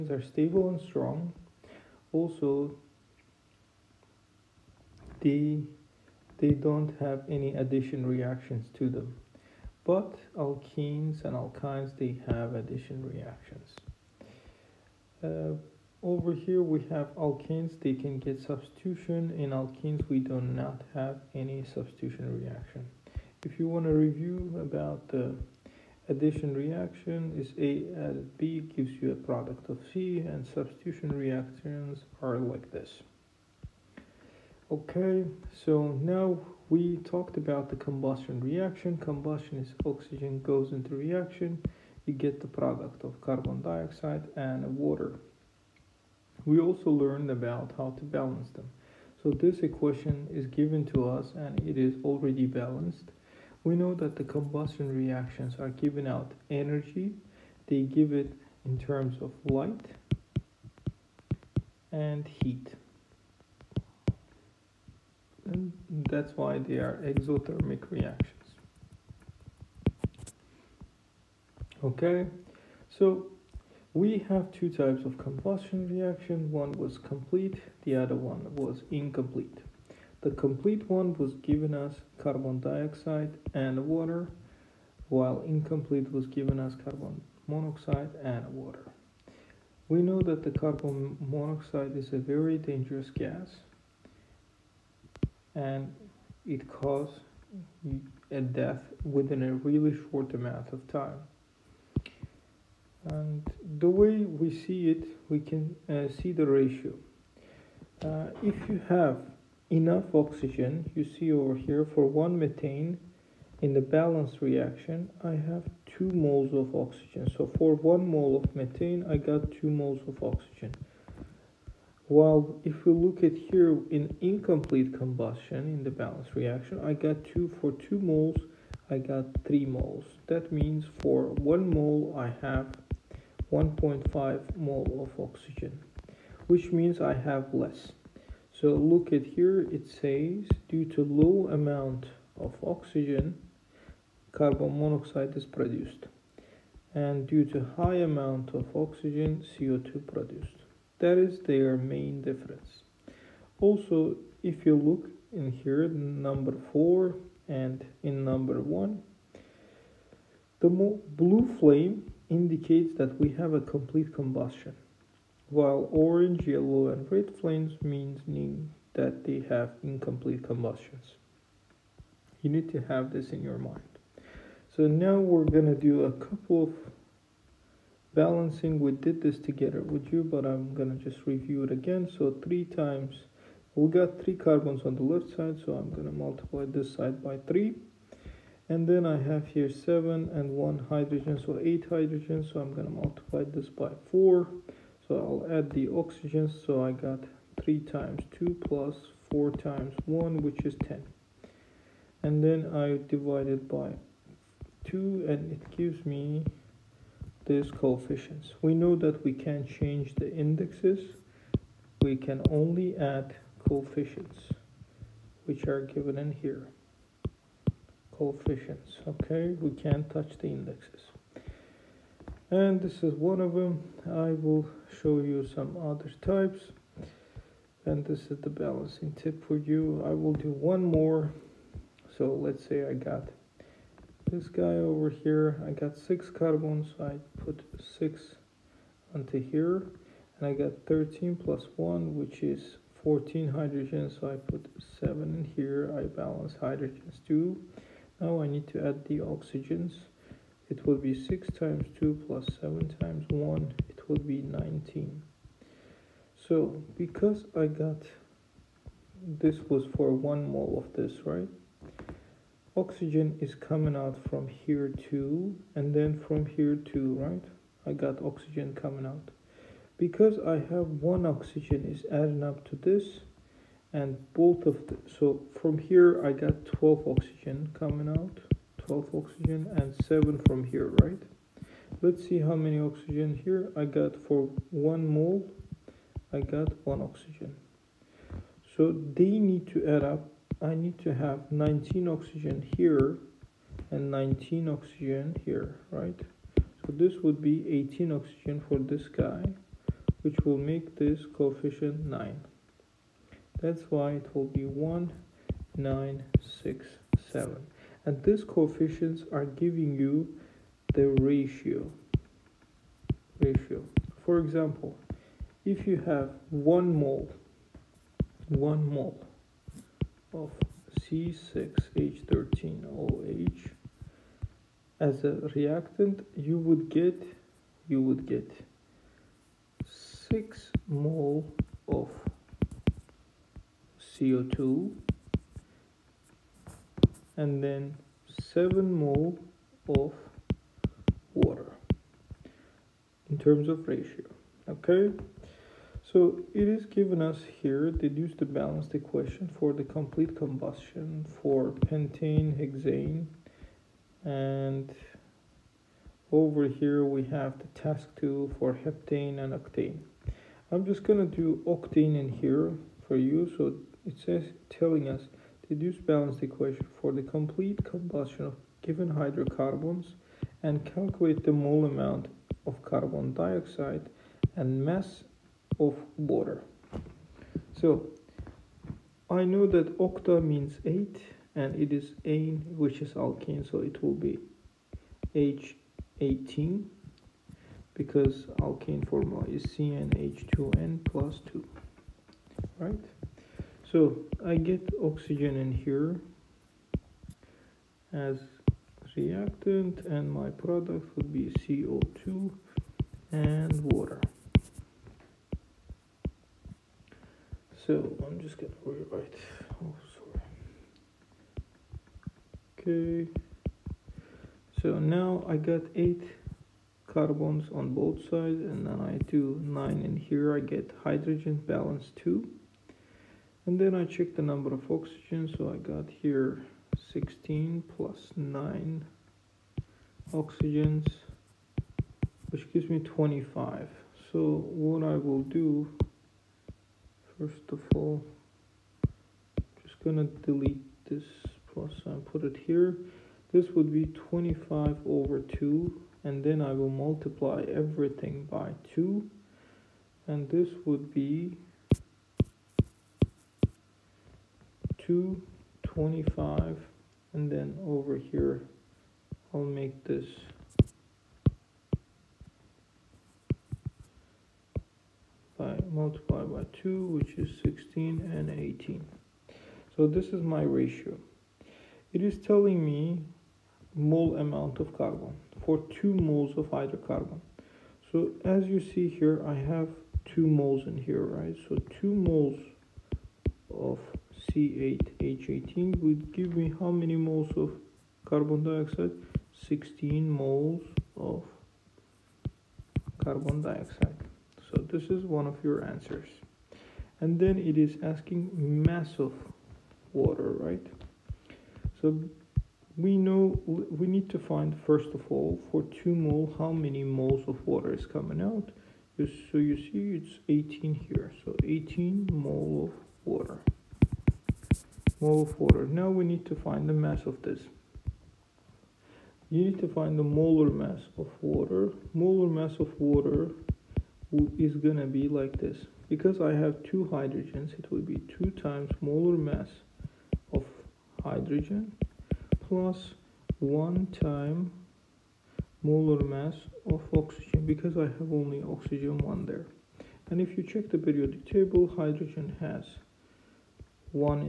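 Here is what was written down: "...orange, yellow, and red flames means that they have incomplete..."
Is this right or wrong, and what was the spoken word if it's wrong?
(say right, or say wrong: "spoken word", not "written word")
right.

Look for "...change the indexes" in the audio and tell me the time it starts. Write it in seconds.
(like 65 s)
209 s.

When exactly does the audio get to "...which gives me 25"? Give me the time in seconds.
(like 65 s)
432 s.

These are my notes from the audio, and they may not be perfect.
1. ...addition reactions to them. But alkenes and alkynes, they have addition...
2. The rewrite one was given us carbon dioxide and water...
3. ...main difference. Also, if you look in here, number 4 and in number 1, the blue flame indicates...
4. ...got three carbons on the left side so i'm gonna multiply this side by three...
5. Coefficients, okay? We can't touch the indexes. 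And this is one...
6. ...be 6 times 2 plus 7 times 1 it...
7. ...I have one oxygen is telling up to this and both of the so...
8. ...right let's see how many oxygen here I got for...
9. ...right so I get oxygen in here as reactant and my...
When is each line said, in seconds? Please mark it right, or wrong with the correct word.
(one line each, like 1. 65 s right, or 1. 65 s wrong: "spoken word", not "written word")
1. 7 s right
2. 80 s wrong: "complete", not "rewrite"
3. 151 s right
4. 183 s right
5. 218 s right
6. 251 s right
7. 270 s wrong: "adding", not "telling"
8. 281 s right
9. 392 s right.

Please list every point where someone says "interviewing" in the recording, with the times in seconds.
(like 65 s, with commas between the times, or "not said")
not said.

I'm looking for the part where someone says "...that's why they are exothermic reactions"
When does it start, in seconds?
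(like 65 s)
66 s.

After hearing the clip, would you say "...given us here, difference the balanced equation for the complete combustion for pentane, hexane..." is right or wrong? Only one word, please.
wrong.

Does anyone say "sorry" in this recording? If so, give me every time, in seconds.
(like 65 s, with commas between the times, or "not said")
410 s.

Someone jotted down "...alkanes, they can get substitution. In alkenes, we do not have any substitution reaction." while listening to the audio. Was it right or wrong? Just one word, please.
right.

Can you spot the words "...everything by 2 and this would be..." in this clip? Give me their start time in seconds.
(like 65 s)
447 s.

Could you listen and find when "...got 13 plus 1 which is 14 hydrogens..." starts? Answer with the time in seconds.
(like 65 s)
240 s.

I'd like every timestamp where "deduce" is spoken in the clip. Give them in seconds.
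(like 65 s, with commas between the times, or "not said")
347 s, 365 s.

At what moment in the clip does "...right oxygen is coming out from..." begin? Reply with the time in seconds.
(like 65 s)
261 s.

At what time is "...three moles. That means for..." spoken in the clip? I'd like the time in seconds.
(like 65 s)
129 s.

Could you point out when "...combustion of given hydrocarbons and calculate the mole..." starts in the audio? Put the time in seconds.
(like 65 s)
367 s.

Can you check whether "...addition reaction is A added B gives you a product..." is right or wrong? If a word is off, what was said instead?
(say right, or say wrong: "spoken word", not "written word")
right.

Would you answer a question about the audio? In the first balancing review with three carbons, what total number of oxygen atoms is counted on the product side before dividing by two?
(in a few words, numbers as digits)
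10.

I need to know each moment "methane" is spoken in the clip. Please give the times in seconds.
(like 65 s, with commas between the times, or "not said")
112 s, 118 s.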